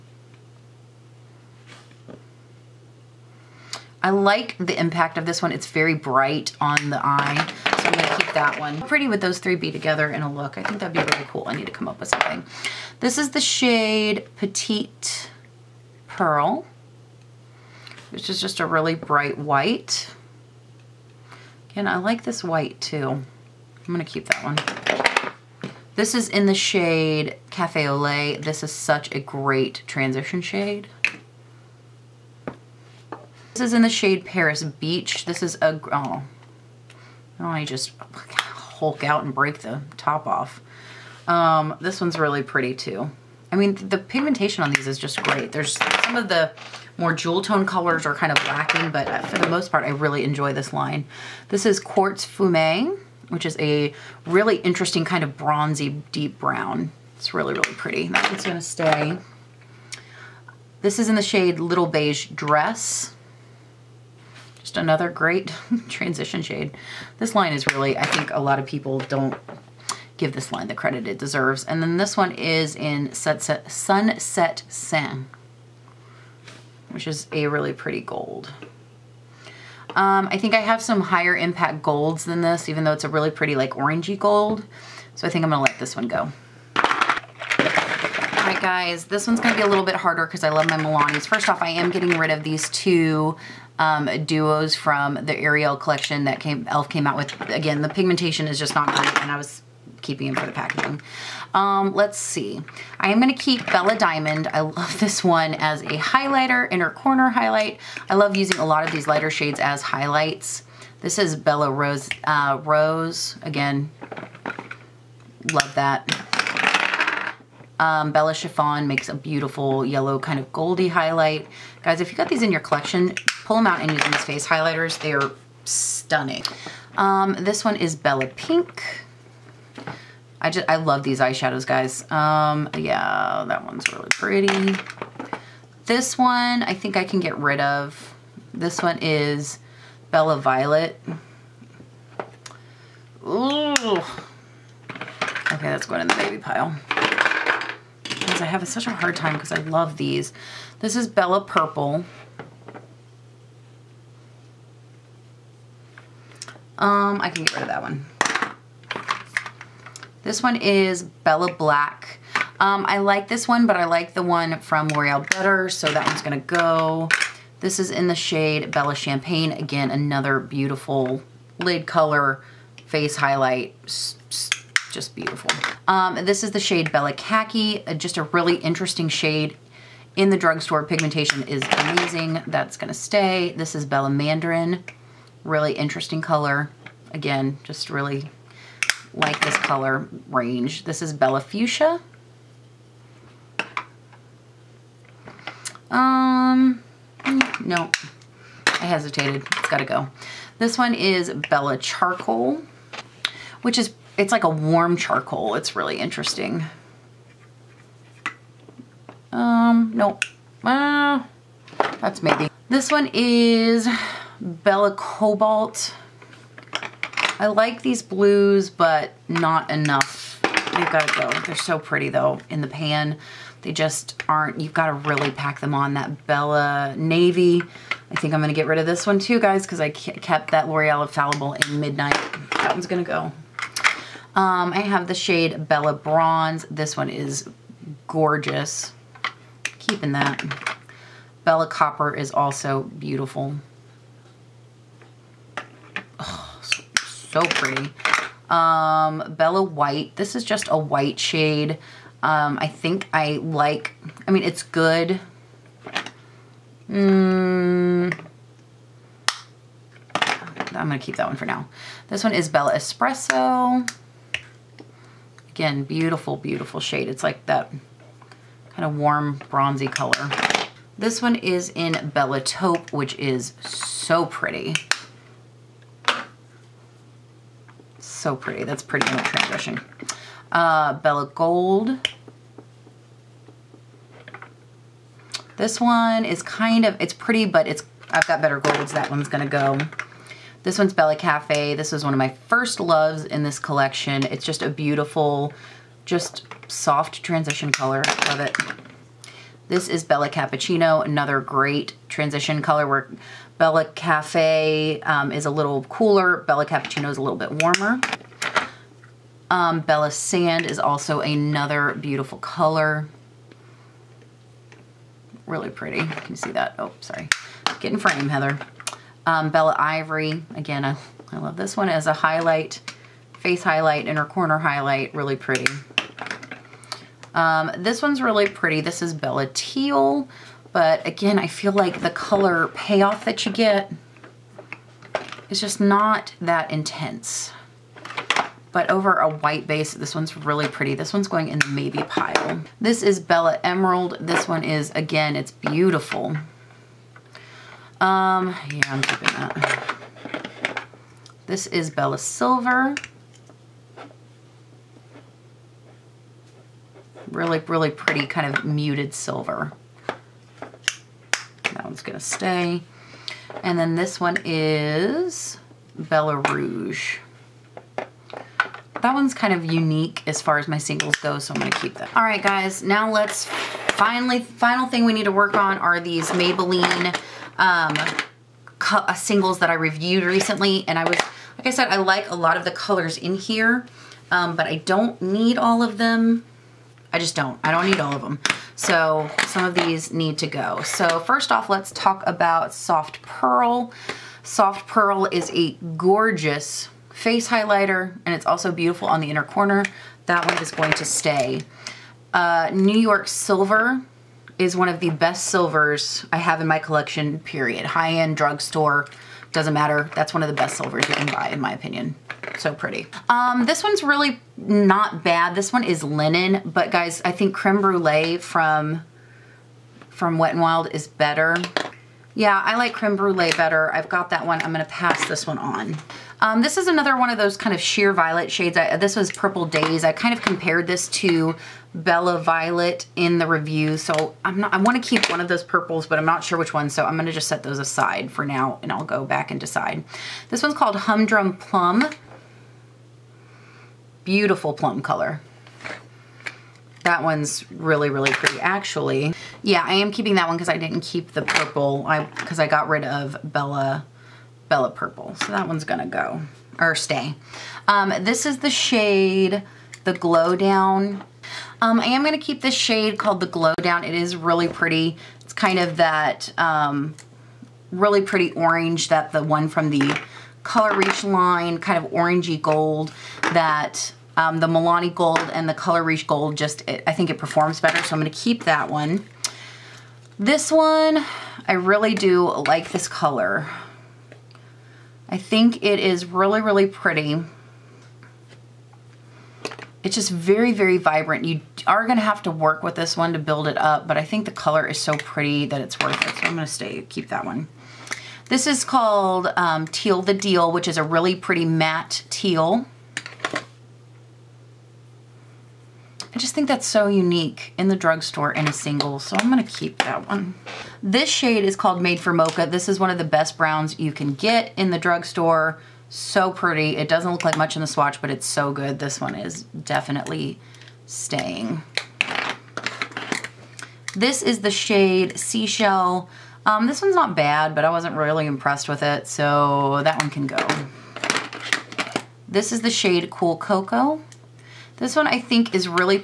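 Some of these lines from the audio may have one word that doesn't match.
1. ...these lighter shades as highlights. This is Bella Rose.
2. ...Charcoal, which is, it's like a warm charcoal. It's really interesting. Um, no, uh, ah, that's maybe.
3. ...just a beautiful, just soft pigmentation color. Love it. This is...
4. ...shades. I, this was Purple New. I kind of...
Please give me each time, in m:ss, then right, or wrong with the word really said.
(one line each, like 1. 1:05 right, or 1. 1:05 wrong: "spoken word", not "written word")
1. 1:48 right
2. 3:21 right
3. 4:54 wrong: "transition", not "pigmentation"
4. 7:08 wrong: "Days", not "New".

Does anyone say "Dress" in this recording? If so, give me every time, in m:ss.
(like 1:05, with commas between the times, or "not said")
1:02.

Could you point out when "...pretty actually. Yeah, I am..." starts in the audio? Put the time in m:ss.
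7:28.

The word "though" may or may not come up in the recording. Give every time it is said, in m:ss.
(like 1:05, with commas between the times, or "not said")
1:22, 3:42.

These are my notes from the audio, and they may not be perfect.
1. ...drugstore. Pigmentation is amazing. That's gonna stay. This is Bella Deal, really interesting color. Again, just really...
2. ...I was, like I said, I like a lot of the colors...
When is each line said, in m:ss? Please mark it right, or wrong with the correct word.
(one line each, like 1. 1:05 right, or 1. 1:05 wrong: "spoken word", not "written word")
1. 3:00 wrong: "Mandarin", not "Deal"
2. 6:20 right.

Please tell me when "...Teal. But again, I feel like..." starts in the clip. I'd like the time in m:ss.
5:29.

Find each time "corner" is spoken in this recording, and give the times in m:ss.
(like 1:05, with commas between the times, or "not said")
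1:46, 5:24, 6:39.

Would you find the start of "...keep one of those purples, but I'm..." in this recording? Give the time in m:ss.
7:15.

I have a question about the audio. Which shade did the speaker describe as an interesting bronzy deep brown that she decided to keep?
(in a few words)
Quartz Fumé.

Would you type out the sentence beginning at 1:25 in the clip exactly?
So I think I'm gonna let this one go.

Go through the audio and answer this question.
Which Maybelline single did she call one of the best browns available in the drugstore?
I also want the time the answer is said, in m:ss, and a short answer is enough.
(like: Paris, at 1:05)
Made for Mocha, at 8:31.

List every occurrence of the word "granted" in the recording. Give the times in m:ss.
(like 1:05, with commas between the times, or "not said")
not said.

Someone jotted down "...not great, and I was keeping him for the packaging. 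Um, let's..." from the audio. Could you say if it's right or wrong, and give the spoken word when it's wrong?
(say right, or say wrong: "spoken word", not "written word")
right.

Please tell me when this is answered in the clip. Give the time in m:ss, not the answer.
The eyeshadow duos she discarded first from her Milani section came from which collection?
1:35.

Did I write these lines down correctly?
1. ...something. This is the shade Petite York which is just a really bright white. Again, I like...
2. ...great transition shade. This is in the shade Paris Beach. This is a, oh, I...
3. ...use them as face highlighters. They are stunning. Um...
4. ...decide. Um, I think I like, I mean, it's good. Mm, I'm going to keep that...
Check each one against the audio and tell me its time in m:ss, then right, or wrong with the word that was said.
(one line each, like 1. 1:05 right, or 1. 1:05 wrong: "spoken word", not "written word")
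1. 0:12 wrong: "Pearl", not "York"
2. 0:29 right
3. 2:03 right
4. 4:11 wrong: "shade", not "decide".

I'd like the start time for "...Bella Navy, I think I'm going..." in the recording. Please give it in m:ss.
3:46.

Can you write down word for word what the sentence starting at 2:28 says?
Because I have such a hard time because I love these.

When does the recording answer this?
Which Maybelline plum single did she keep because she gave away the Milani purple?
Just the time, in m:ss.
7:20.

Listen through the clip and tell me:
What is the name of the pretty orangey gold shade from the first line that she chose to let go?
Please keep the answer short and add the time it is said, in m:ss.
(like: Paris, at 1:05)
Sunset Sand, at 1:13.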